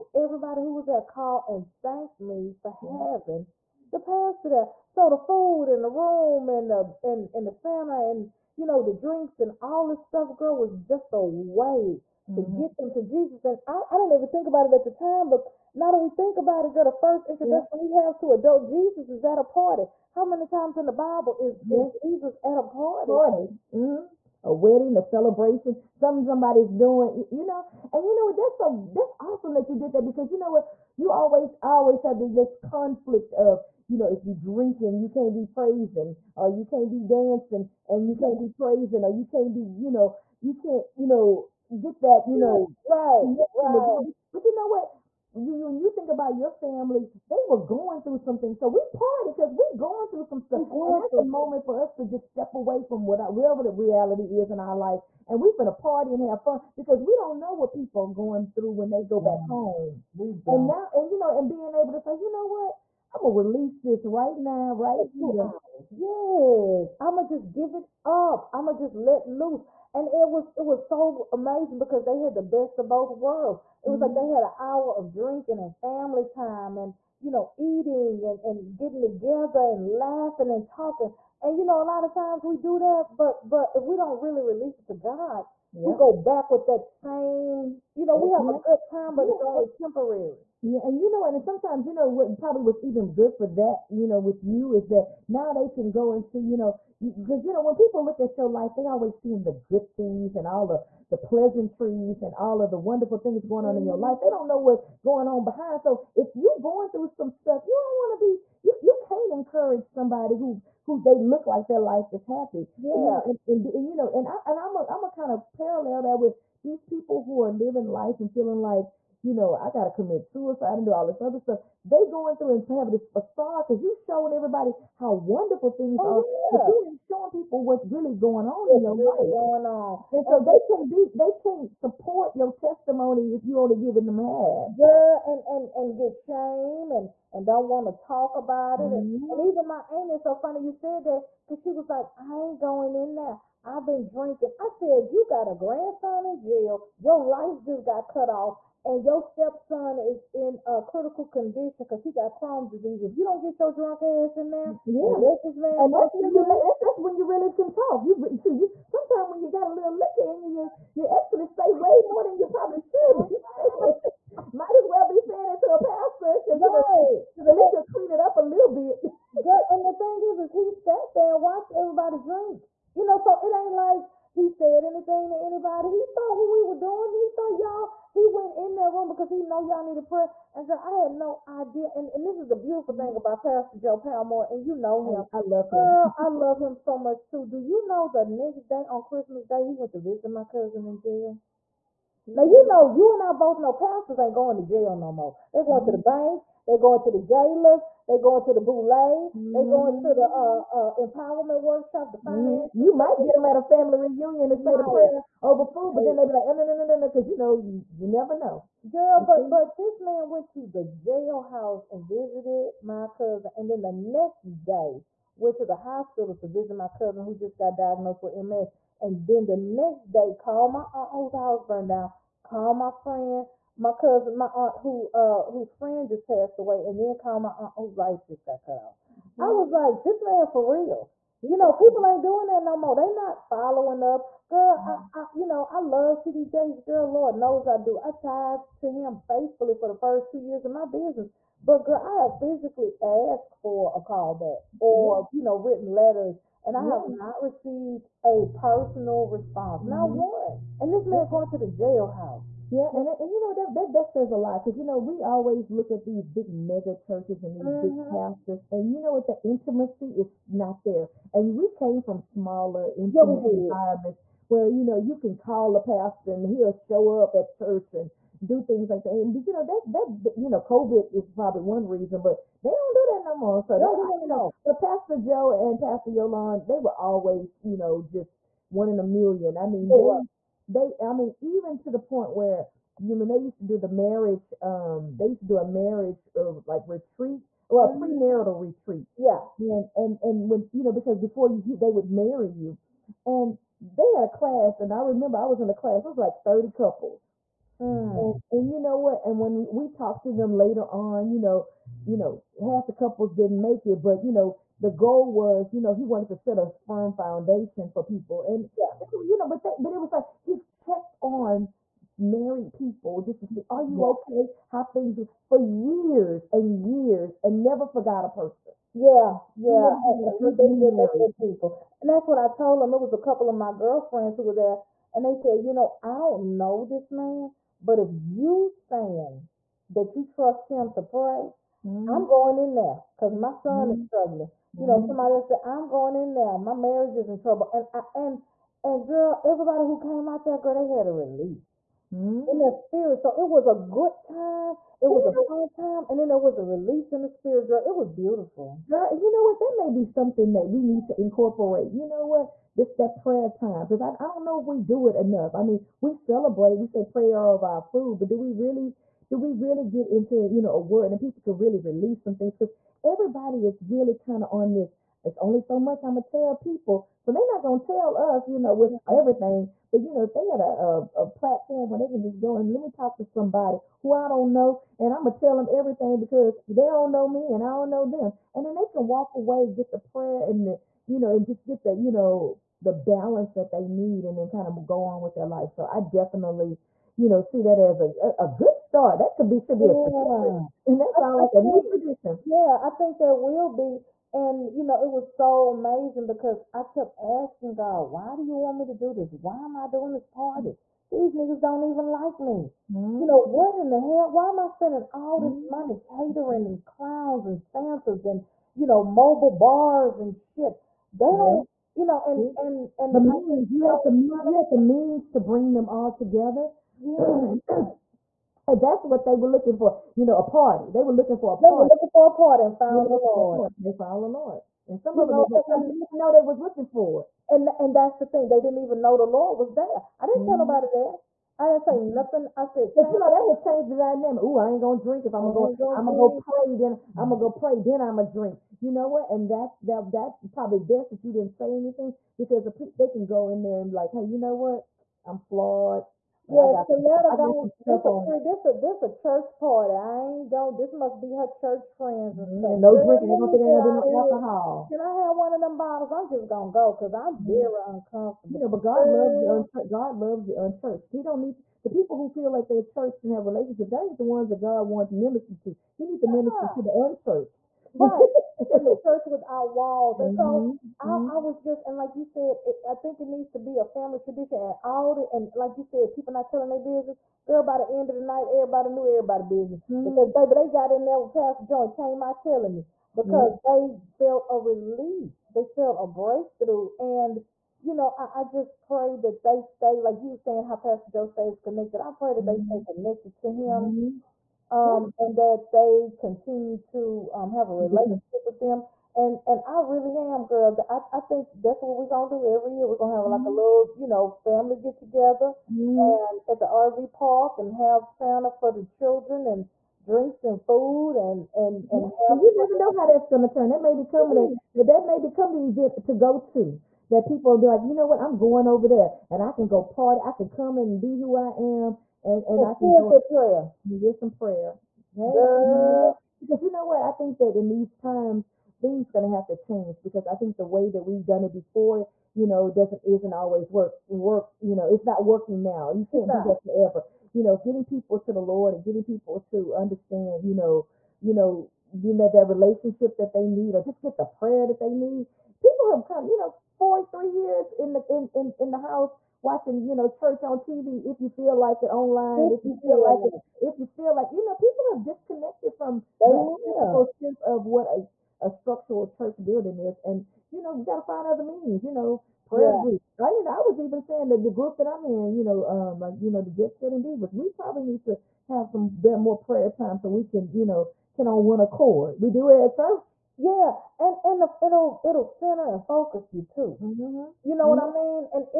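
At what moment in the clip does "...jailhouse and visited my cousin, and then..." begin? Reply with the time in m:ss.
3:30.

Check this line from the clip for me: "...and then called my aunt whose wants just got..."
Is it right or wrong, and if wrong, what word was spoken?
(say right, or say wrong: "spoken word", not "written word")
wrong: "lights", not "wants".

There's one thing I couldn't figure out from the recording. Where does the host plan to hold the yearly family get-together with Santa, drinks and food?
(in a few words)
The RV park.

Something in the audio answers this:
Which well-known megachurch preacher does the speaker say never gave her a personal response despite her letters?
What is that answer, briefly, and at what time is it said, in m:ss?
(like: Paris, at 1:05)
T.D. Jakes, at 3:56.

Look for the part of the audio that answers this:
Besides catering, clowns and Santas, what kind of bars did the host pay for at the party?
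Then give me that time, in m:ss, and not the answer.
6:49.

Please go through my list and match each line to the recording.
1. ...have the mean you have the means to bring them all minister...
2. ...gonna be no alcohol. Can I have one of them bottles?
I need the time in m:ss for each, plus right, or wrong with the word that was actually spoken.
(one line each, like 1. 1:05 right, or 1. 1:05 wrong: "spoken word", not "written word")
1. 6:53 wrong: "together", not "minister"
2. 7:33 right.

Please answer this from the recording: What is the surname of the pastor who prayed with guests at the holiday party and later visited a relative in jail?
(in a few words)
Palmore.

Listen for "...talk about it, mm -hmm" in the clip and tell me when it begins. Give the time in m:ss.
2:18.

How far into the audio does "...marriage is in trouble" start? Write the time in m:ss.
5:36.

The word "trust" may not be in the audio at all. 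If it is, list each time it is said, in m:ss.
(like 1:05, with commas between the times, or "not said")
5:30.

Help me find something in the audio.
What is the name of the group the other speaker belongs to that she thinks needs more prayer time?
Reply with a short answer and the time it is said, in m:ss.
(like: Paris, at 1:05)
Jet Setting Divas, at 9:26.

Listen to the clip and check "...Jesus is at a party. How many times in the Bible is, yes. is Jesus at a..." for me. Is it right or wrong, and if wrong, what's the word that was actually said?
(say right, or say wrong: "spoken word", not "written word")
right.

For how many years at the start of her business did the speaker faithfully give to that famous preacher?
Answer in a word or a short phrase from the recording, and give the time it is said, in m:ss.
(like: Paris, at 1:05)
2, at 4:00.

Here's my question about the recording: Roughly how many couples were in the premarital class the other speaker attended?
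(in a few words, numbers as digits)
30.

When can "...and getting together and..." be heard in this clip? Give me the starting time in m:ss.
1:18.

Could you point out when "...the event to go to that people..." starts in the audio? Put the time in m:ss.
8:35.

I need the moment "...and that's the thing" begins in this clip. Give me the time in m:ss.
7:07.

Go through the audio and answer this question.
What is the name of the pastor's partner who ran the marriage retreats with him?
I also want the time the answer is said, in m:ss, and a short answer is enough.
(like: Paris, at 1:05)
Pastor Yolan, at 4:35.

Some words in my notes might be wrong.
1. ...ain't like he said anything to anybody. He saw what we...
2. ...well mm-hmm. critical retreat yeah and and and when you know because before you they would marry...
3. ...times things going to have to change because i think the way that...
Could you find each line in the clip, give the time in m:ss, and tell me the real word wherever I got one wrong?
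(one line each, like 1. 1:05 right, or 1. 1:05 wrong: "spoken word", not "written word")
1. 2:53 right
2. 4:47 wrong: "premarital", not "critical"
3. 8:47 right.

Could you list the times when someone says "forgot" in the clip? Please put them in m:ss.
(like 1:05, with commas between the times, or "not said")
5:17.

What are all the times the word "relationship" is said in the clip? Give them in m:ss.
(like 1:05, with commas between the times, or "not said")
7:43, 8:17, 9:02.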